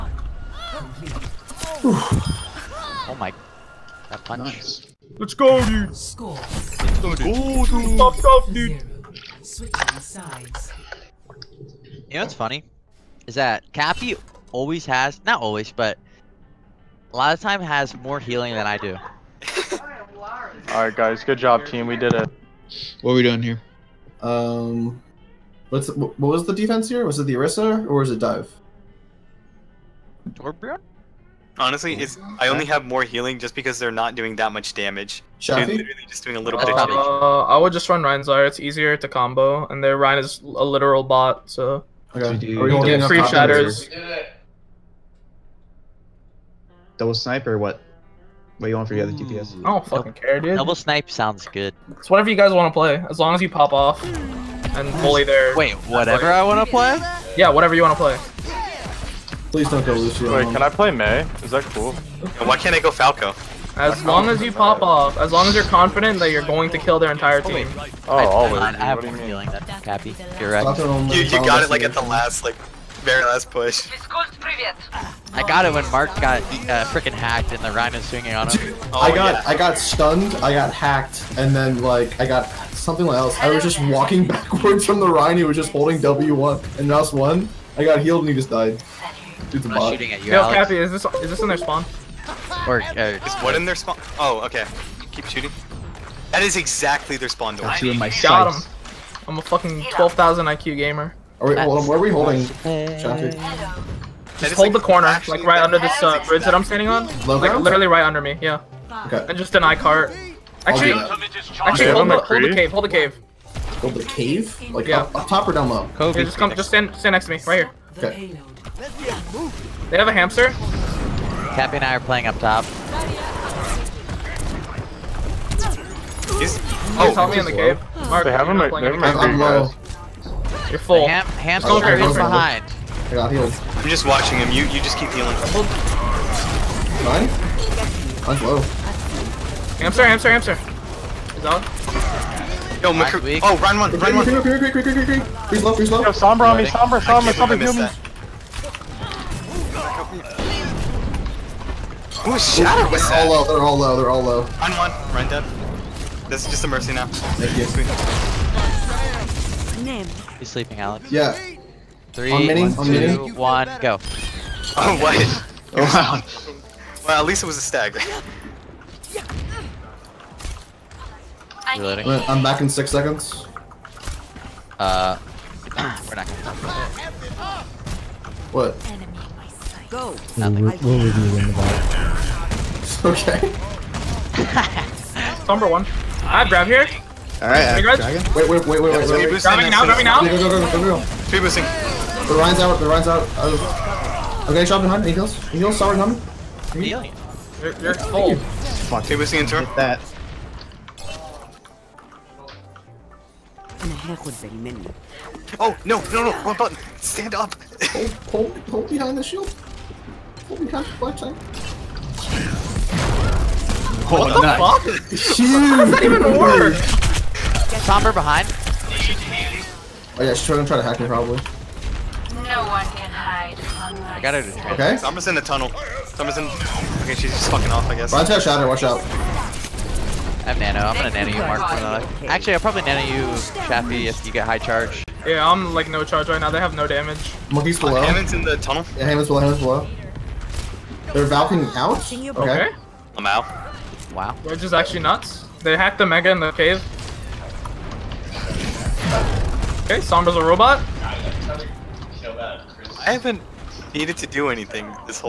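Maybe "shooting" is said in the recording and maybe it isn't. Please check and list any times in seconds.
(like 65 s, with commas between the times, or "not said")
89 s, 95 s.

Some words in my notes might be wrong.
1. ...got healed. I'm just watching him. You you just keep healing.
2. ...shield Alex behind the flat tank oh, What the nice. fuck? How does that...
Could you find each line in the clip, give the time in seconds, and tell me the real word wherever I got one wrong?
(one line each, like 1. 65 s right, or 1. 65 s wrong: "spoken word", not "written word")
1. 133 s right
2. 209 s wrong: "Hold", not "Alex".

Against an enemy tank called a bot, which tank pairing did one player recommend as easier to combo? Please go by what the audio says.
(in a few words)
Rhinezar.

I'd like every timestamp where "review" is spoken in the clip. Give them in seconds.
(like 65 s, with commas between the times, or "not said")
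181 s.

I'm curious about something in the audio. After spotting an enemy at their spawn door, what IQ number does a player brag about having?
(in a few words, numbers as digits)
12,000.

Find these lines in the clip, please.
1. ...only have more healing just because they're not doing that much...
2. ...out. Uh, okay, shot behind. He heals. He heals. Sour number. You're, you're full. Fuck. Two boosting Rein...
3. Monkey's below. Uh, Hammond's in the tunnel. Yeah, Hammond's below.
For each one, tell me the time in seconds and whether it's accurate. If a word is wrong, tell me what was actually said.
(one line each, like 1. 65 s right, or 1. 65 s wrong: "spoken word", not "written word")
1. 32 s right
2. 193 s wrong: "Turn", not "Rein"
3. 237 s right.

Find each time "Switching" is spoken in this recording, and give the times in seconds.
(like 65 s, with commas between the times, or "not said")
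9 s.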